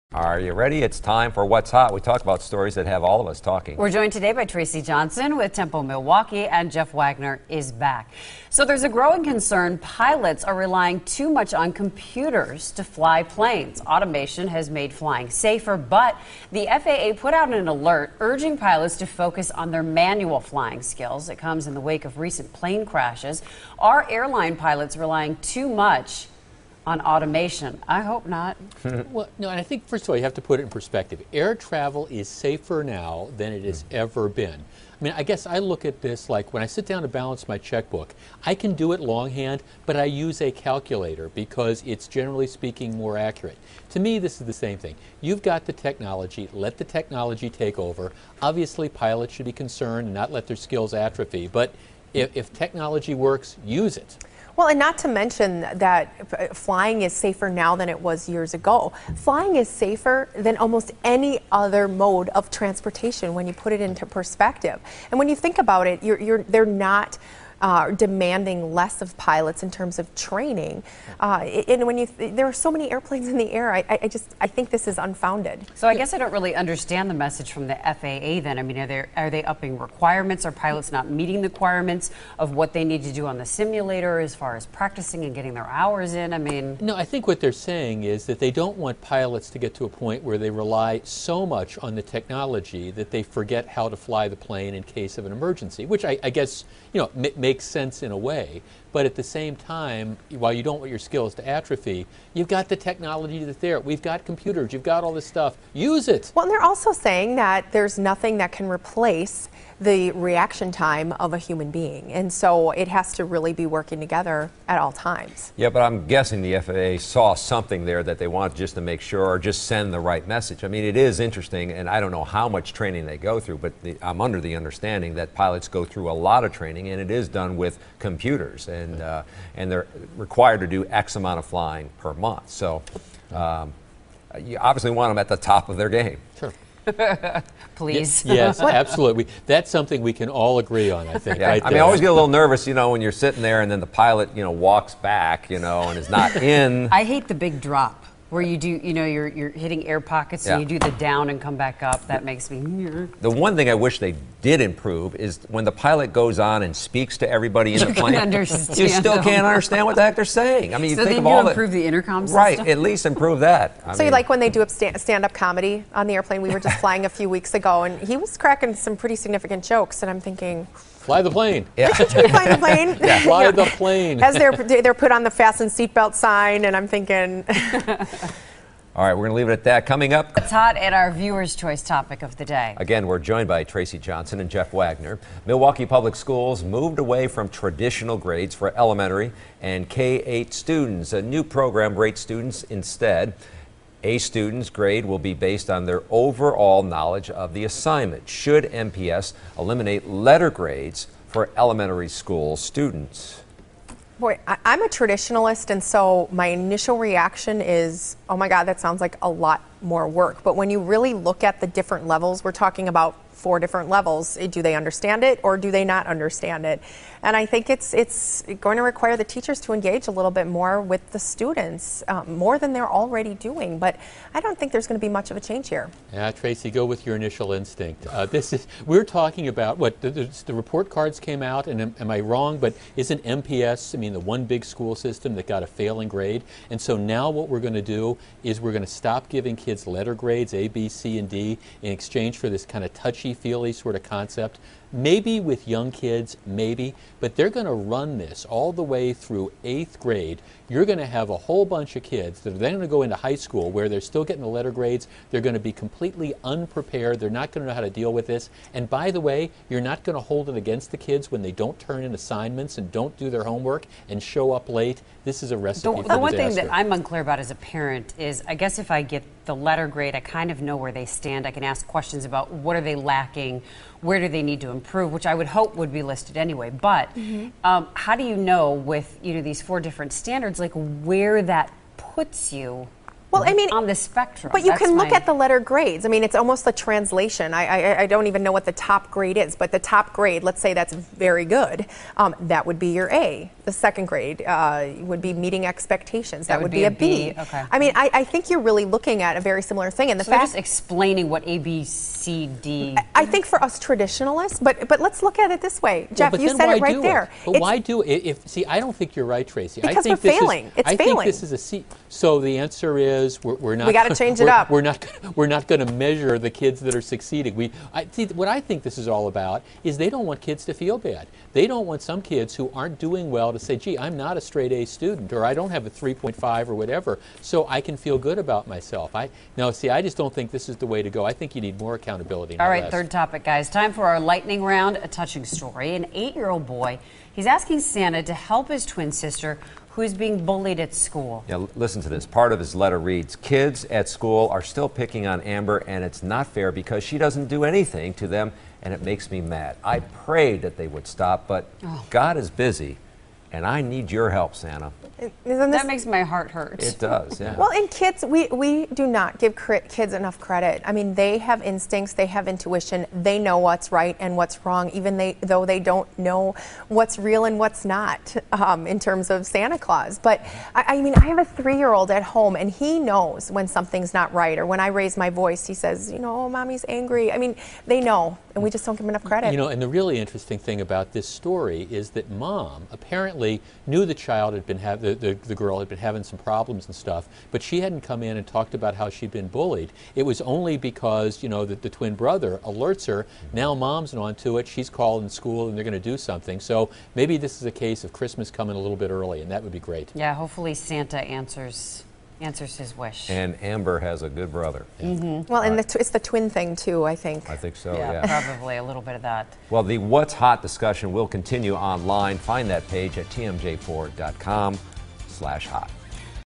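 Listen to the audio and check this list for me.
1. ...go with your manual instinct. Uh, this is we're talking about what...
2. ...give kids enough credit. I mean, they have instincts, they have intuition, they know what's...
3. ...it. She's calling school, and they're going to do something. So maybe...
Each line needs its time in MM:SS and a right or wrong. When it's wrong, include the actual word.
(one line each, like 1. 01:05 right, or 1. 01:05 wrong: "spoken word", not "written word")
1. 03:46 wrong: "initial", not "manual"
2. 05:59 right
3. 06:34 right.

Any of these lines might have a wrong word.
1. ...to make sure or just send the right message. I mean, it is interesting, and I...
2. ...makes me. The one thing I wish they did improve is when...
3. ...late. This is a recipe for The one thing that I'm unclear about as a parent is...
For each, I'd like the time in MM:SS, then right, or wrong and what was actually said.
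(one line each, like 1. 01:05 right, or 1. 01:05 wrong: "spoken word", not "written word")
1. 01:58 right
2. 02:32 right
3. 04:24 right.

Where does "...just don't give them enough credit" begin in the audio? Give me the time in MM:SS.
06:18.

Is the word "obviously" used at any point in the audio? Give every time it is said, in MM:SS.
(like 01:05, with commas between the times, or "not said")
00:48, 02:14.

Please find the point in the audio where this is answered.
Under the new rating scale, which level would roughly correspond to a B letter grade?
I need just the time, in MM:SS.
04:55.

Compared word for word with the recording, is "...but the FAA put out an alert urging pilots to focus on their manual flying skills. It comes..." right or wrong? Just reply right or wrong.
right.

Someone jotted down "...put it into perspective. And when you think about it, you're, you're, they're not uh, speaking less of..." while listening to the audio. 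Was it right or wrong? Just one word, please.
wrong.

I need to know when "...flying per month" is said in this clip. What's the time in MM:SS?
02:11.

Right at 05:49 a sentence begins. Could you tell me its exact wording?
I prayed that they would stop, but oh.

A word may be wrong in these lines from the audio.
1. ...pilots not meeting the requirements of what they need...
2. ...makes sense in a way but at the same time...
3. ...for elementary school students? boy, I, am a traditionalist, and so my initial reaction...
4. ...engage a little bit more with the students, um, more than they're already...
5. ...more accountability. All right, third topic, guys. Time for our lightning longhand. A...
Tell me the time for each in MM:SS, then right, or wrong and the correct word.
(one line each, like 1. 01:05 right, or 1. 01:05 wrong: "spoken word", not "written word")
1. 01:20 right
2. 01:37 right
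3. 03:21 right
4. 03:39 right
5. 05:31 wrong: "round", not "longhand".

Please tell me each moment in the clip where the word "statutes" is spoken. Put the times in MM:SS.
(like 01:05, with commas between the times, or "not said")
not said.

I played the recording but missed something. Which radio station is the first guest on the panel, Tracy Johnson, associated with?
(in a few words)
Tempo Milwaukee.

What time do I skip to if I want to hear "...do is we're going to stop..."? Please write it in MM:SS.
03:57.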